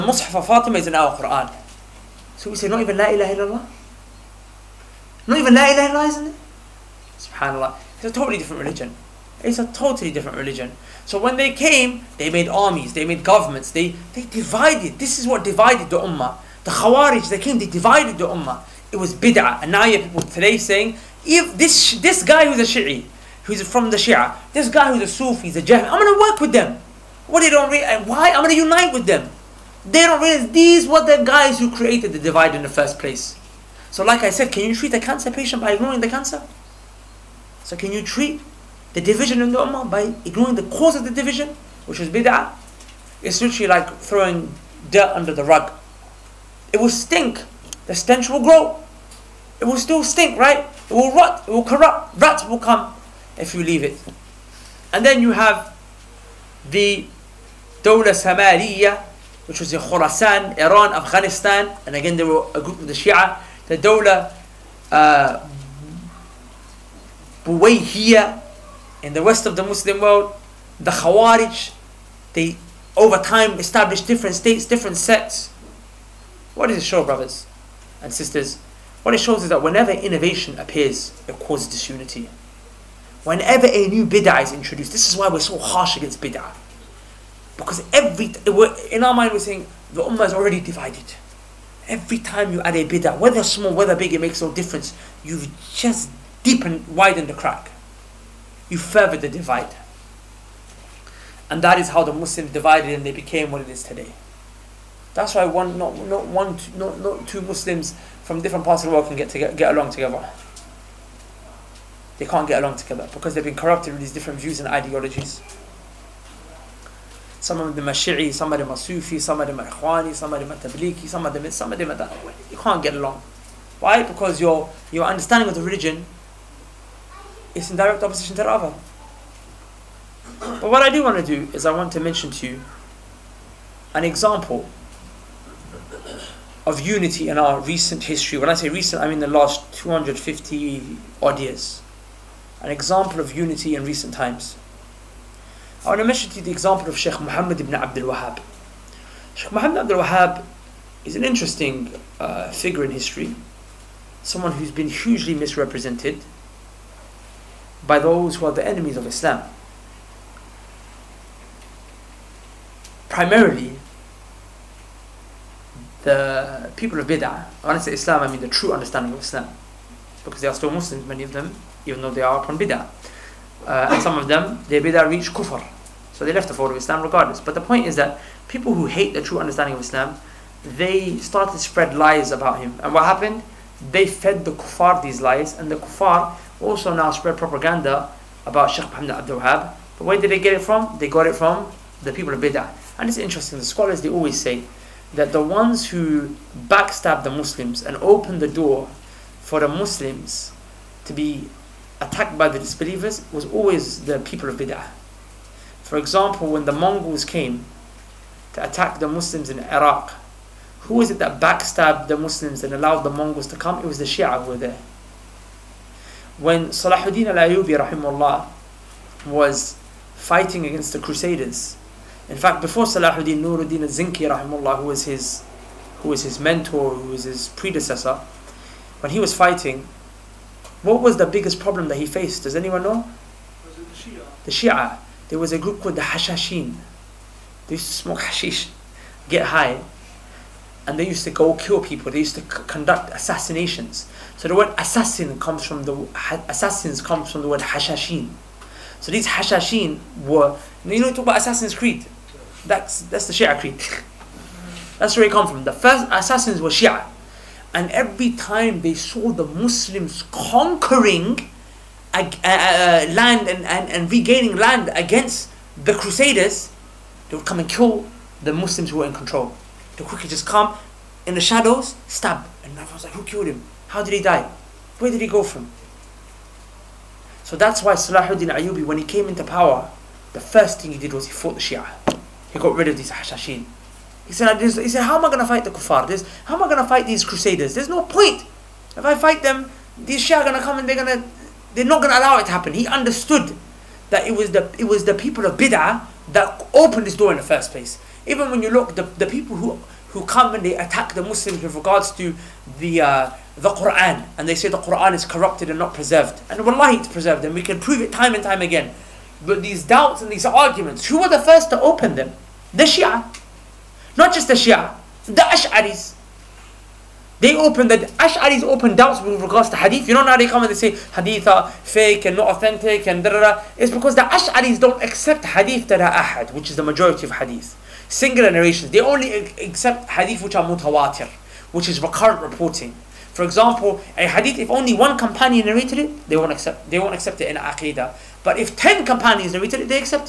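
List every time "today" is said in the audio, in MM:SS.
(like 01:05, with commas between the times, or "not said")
00:20, 01:43.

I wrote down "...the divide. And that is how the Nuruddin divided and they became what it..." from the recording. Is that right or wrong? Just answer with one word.
wrong.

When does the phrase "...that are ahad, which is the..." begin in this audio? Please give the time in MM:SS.
05:25.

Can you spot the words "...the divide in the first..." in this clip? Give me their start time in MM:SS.
00:32.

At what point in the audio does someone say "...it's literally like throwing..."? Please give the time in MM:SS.
00:43.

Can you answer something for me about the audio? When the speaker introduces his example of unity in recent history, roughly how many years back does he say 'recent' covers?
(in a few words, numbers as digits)
250.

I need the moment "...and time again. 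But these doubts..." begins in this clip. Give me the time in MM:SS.
05:08.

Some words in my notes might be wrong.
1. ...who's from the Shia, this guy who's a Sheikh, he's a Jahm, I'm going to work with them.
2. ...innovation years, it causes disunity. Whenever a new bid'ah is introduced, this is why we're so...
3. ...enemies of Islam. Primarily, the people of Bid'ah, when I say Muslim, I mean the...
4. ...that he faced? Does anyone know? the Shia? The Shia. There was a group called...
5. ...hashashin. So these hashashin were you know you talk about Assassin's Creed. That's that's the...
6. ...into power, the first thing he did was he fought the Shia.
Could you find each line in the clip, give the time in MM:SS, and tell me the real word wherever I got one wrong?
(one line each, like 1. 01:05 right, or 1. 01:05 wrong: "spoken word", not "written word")
1. 00:23 wrong: "Sufi", not "Sheikh"
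2. 01:19 wrong: "appears", not "years"
3. 02:38 wrong: "Islam", not "Muslim"
4. 03:51 right
5. 04:07 right
6. 04:39 right.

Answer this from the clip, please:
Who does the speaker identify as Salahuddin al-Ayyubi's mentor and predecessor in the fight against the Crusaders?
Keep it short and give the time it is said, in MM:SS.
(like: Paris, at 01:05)
Nuruddin al-Zinki, at 03:43.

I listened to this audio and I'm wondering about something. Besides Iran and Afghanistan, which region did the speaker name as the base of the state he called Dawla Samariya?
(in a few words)
Khurasan.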